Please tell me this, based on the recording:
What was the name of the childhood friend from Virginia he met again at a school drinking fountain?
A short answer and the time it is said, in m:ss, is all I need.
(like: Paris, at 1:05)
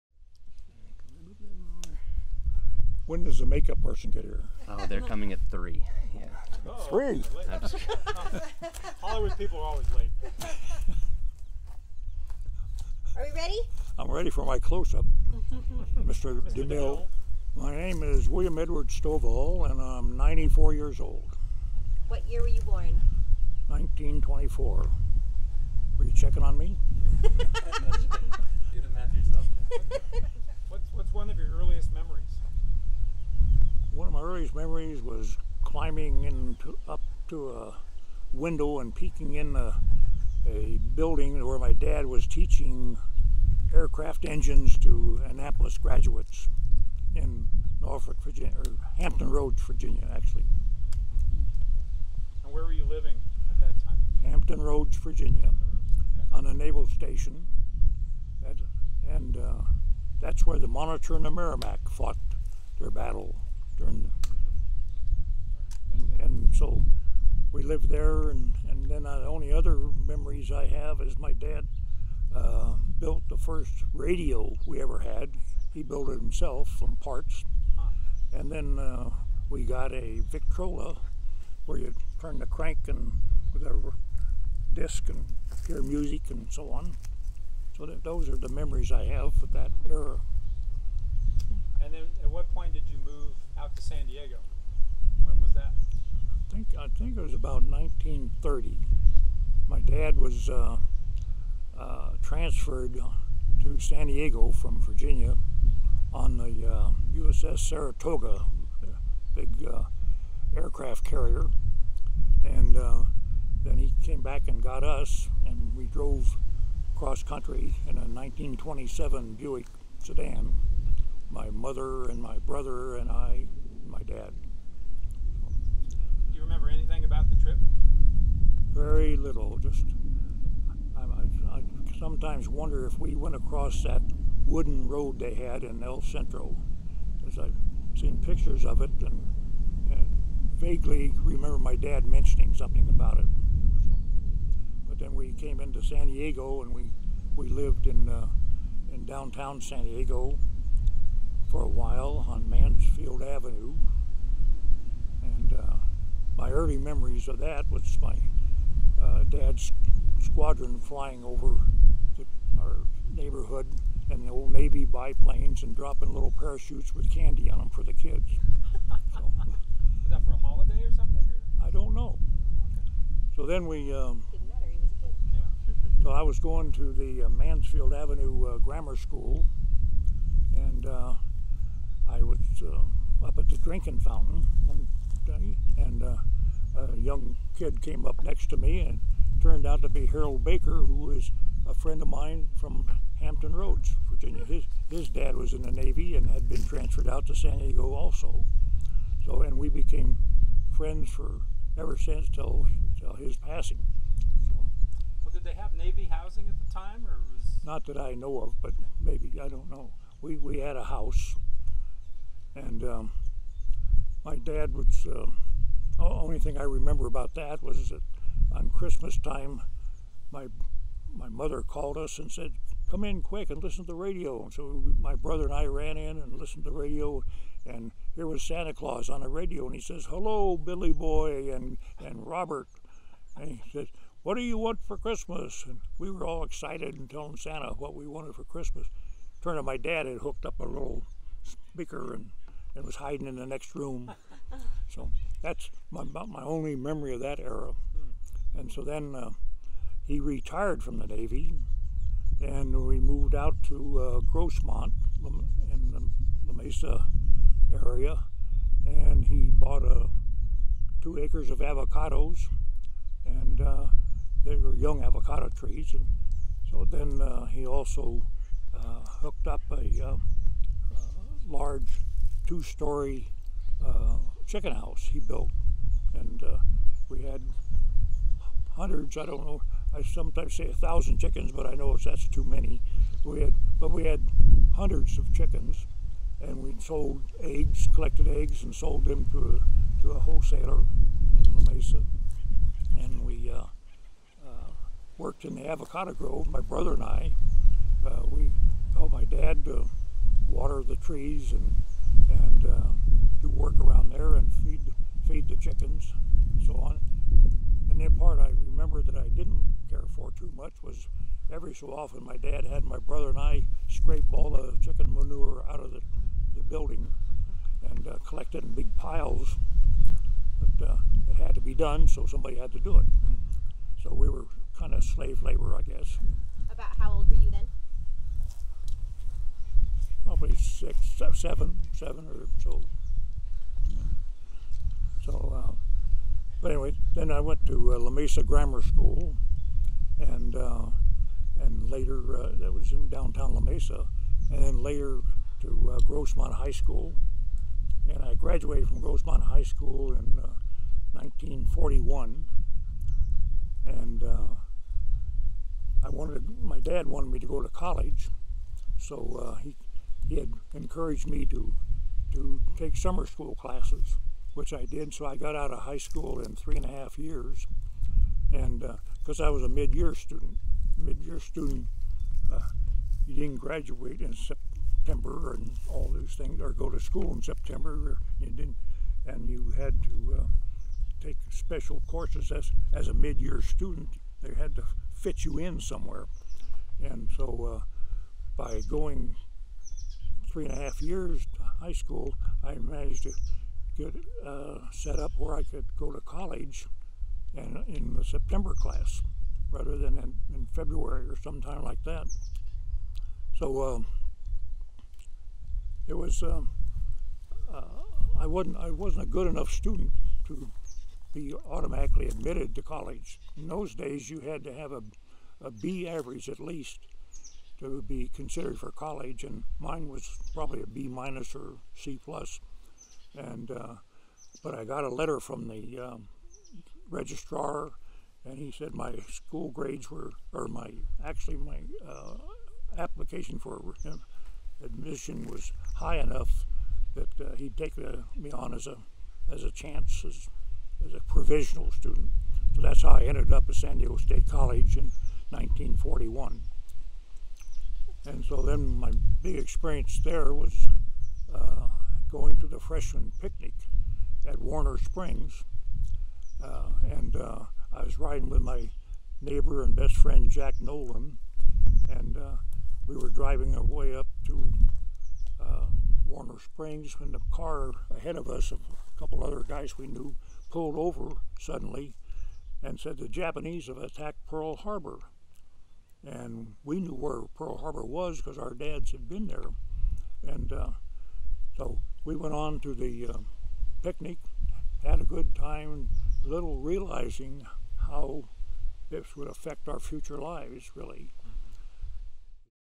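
Harold Baker, at 3:10.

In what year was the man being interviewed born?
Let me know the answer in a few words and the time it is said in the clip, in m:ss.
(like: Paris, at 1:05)
1924, at 0:23.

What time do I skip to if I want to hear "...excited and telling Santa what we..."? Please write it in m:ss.
3:56.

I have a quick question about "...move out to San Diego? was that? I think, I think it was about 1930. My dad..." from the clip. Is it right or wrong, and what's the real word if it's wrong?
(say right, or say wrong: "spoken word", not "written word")
right.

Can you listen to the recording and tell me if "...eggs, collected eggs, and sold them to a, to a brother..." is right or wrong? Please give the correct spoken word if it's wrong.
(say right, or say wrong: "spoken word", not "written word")
wrong: "wholesaler", not "brother".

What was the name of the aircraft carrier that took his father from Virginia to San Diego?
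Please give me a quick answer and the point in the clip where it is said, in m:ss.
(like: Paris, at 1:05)
USS Saratoga, at 1:47.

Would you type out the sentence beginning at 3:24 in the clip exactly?
So, well, did they have Navy housing at the time, or was not that I know of, but maybe I don't know.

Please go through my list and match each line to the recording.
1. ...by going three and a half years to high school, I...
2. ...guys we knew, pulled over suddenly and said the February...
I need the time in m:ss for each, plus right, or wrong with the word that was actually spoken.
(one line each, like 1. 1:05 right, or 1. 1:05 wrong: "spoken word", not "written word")
1. 6:28 right
2. 7:49 wrong: "Japanese", not "February".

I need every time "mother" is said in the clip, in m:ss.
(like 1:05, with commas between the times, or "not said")
2:01, 3:41.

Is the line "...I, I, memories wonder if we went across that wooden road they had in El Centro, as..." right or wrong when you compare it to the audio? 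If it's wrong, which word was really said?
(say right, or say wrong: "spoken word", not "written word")
wrong: "sometimes", not "memories".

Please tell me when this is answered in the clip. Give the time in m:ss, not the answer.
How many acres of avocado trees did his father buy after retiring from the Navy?
4:21.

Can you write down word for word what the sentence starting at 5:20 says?
But uh, it had to be done, so somebody had to do it.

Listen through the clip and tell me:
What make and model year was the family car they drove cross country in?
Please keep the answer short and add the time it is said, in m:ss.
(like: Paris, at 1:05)
1927 Buick, at 1:58.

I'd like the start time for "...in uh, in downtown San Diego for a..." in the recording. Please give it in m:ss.
2:27.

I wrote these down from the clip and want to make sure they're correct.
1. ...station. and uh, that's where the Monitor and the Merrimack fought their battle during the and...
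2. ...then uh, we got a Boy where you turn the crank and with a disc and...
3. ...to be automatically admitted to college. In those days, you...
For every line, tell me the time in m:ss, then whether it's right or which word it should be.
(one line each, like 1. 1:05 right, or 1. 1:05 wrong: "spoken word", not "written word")
1. 0:56 right
2. 1:18 wrong: "Victrola", not "Boy"
3. 6:50 right.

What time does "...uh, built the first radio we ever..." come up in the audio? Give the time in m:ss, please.
1:12.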